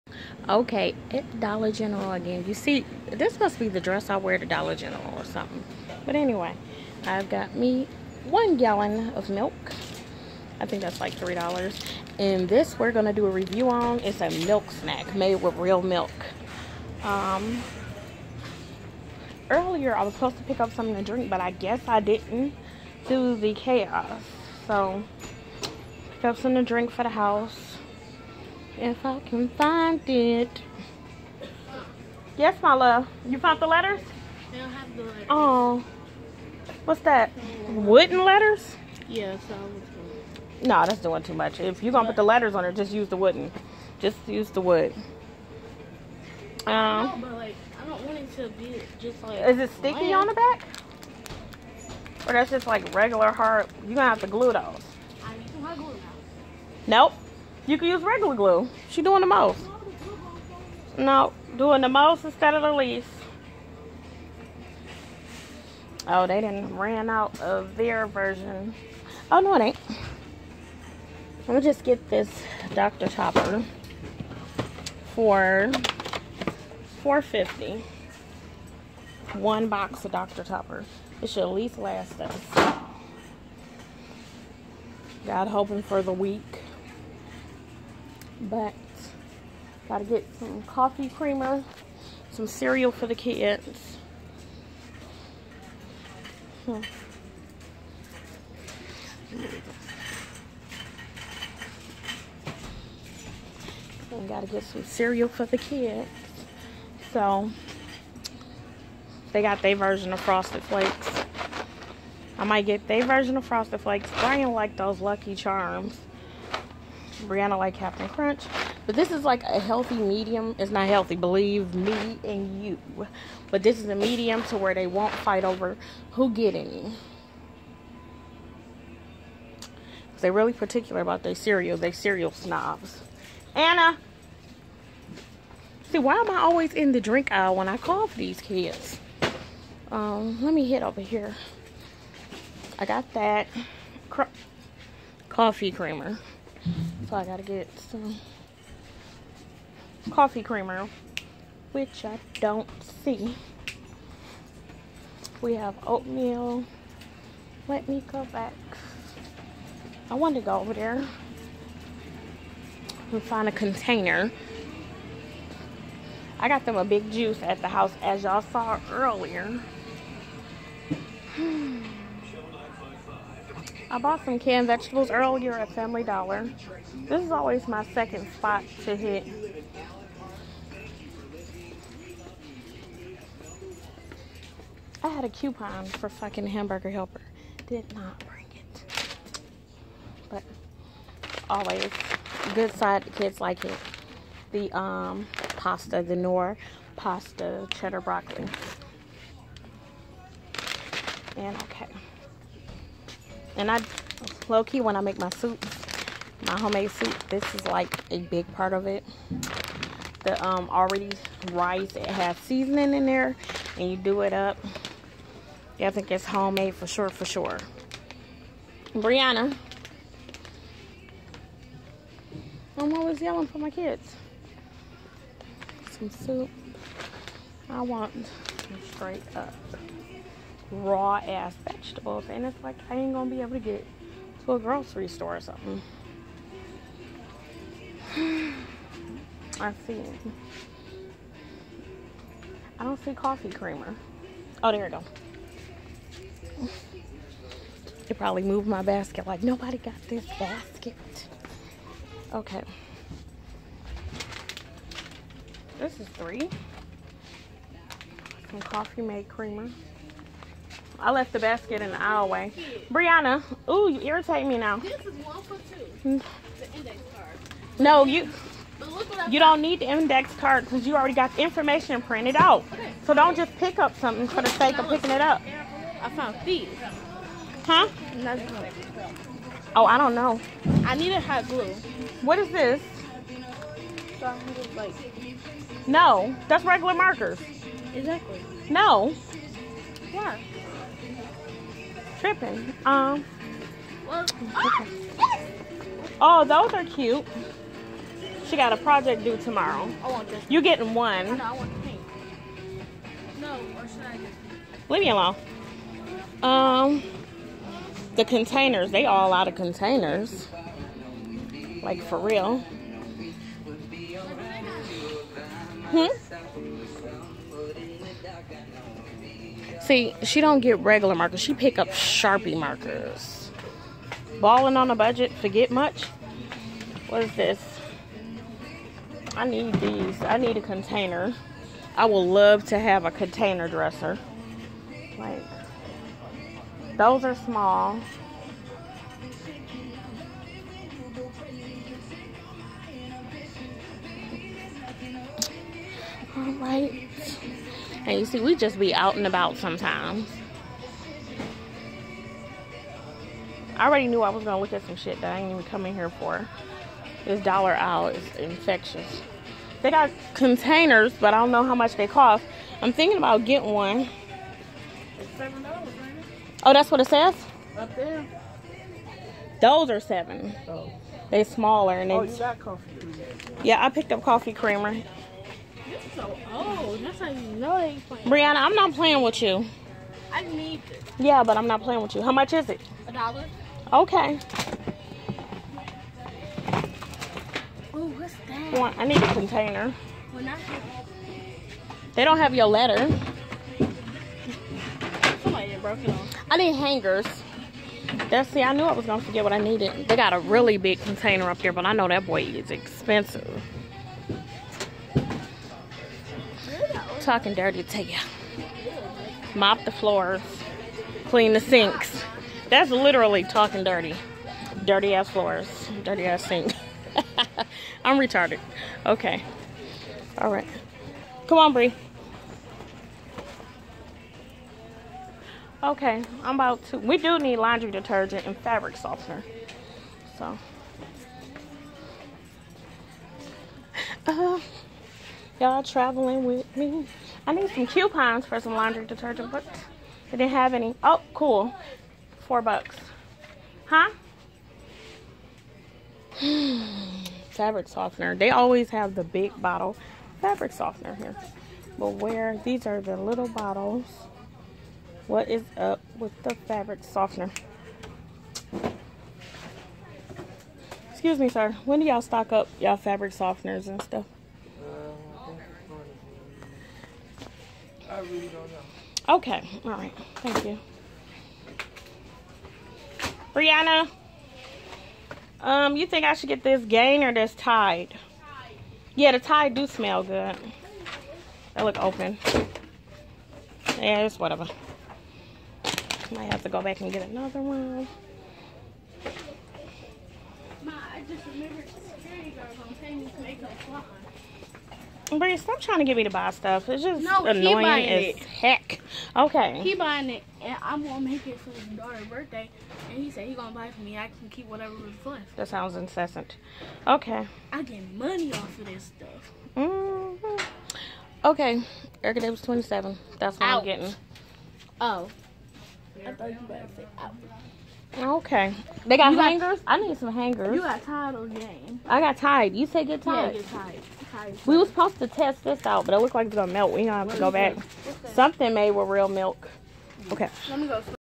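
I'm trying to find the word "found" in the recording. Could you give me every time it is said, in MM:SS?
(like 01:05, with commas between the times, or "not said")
00:33, 04:36.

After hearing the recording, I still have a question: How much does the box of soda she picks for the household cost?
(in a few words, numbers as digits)
450.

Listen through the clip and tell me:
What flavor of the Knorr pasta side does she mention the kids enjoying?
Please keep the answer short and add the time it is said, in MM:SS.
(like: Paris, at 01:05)
cheddar broccoli, at 03:17.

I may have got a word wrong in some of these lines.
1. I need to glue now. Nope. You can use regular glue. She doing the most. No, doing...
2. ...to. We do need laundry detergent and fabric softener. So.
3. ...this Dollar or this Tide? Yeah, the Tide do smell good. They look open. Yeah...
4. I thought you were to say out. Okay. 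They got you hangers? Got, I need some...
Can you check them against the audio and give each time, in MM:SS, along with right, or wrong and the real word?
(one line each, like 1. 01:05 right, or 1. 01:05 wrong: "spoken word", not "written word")
1. 00:55 right
2. 07:06 right
3. 07:56 wrong: "Gain", not "Dollar"
4. 08:36 right.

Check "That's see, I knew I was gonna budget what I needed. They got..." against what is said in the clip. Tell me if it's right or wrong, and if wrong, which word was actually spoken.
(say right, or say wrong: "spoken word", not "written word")
wrong: "forget", not "budget".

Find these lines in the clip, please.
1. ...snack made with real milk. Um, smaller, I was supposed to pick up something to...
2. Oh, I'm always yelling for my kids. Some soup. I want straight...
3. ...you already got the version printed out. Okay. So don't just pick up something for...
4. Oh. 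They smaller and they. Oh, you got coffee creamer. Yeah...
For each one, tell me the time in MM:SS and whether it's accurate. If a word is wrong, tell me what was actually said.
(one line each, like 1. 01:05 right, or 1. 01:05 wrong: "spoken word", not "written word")
1. 00:14 wrong: "earlier", not "smaller"
2. 03:42 right
3. 04:30 wrong: "information", not "version"
4. 06:10 right.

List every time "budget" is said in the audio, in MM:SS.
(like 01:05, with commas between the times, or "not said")
05:24.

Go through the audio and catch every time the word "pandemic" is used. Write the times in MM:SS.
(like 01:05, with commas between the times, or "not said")
not said.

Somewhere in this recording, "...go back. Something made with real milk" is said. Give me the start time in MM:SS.
08:47.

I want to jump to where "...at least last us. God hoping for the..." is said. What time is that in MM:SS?
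01:21.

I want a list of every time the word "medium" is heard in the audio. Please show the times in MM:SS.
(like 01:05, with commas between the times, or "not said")
01:59, 02:03.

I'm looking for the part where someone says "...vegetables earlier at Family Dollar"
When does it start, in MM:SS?
02:54.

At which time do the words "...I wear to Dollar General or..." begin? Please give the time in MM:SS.
00:04.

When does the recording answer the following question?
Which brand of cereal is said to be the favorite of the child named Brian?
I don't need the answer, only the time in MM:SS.
01:54.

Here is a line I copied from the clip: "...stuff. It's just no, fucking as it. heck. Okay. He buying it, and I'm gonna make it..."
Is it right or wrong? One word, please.
wrong.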